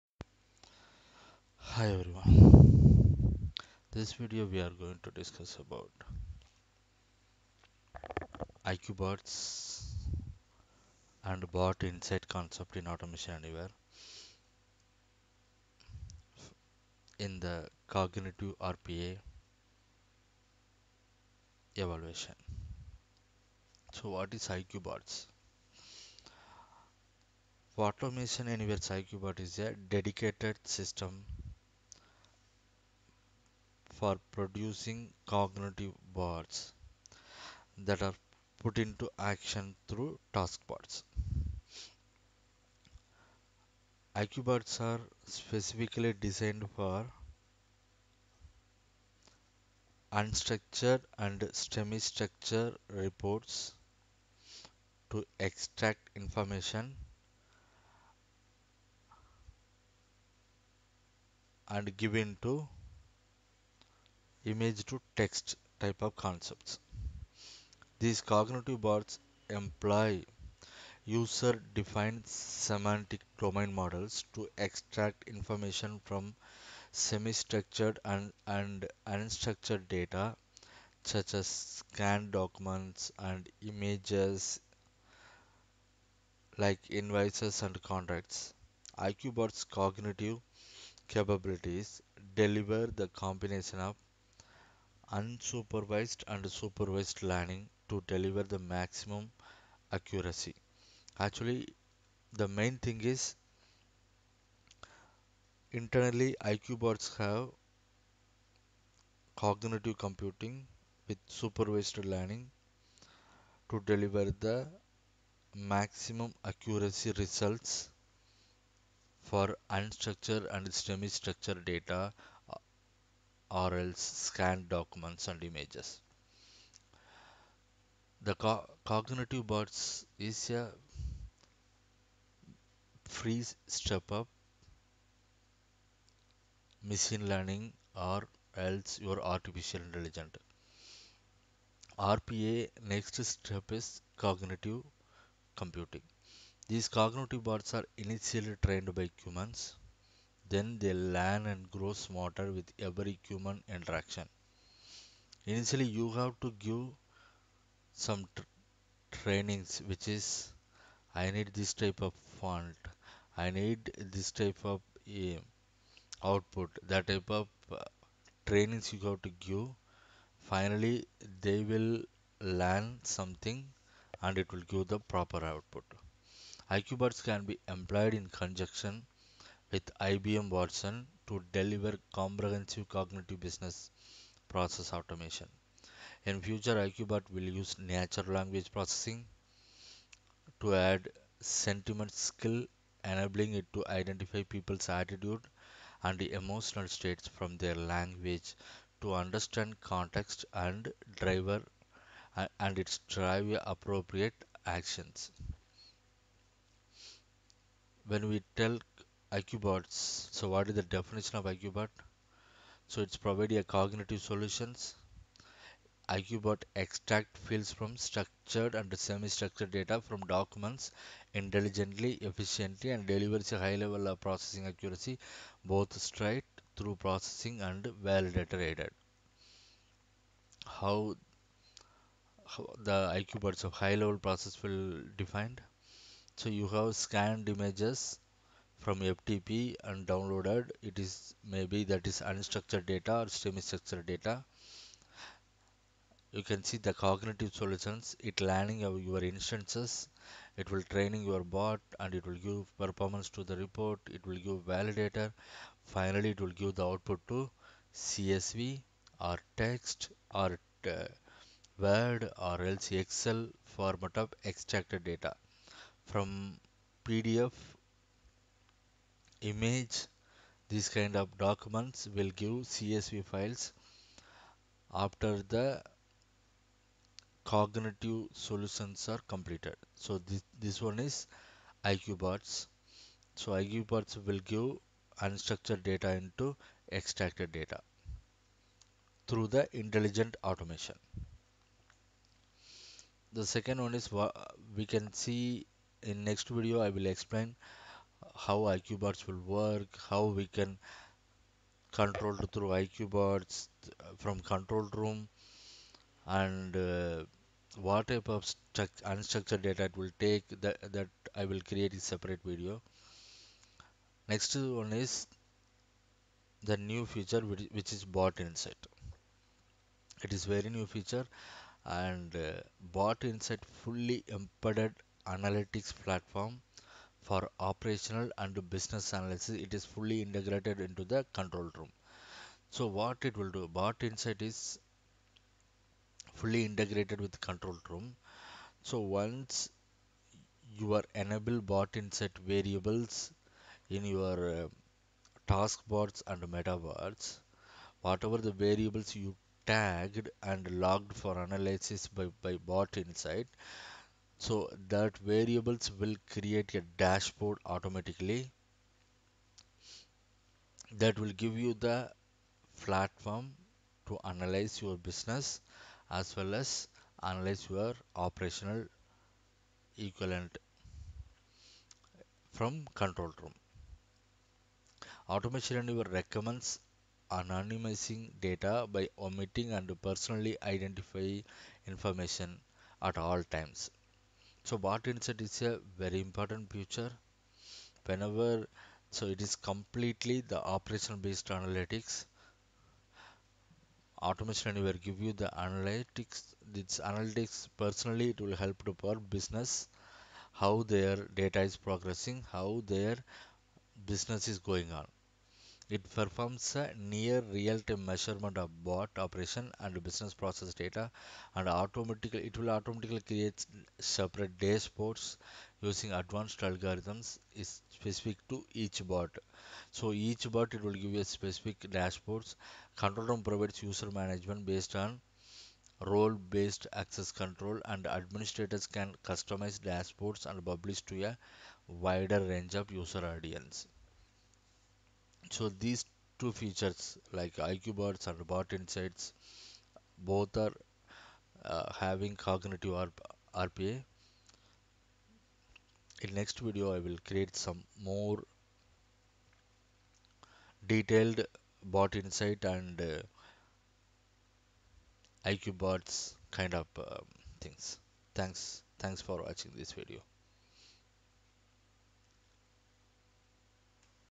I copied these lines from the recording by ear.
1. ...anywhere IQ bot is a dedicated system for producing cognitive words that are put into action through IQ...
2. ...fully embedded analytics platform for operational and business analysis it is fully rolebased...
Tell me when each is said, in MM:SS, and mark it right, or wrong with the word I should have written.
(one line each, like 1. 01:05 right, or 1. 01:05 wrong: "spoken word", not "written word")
1. 00:28 right
2. 05:23 wrong: "integrated", not "rolebased".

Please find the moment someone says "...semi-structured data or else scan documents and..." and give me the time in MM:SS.
02:00.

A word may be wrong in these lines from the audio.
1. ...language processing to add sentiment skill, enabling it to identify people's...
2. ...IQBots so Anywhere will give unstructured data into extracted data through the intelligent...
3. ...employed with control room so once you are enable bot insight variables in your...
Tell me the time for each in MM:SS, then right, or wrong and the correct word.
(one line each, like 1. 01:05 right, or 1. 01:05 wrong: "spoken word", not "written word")
1. 03:08 right
2. 04:41 wrong: "IQBots", not "Anywhere"
3. 05:36 wrong: "integrated", not "employed".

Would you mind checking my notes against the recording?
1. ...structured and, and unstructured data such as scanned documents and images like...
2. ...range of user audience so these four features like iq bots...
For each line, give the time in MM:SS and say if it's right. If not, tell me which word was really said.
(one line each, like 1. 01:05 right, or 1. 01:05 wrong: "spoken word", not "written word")
1. 01:17 right
2. 07:12 wrong: "two", not "four".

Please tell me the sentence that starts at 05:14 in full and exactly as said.
Next one is the new feature which, which is bot insight.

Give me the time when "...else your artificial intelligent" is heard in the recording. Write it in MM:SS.
02:18.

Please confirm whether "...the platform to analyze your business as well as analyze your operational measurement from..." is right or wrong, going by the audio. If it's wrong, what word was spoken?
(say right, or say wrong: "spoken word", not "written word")
wrong: "equivalent", not "measurement".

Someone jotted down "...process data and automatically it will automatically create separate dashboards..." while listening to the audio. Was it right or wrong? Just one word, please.
right.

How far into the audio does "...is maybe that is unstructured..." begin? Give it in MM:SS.
04:01.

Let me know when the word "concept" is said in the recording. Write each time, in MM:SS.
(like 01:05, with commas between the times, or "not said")
00:12, 01:06.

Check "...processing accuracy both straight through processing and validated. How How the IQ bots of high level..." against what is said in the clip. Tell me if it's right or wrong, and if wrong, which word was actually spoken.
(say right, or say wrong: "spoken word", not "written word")
right.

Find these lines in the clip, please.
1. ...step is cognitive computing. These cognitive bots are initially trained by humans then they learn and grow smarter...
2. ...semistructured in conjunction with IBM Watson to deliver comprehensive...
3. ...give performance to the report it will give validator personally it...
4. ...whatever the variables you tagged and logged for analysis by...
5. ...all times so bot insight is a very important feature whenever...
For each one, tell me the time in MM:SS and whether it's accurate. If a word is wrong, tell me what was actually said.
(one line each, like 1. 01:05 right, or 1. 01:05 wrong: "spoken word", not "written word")
1. 02:23 right
2. 02:57 wrong: "employed", not "semistructured"
3. 04:12 wrong: "finally", not "personally"
4. 05:48 right
5. 06:23 right.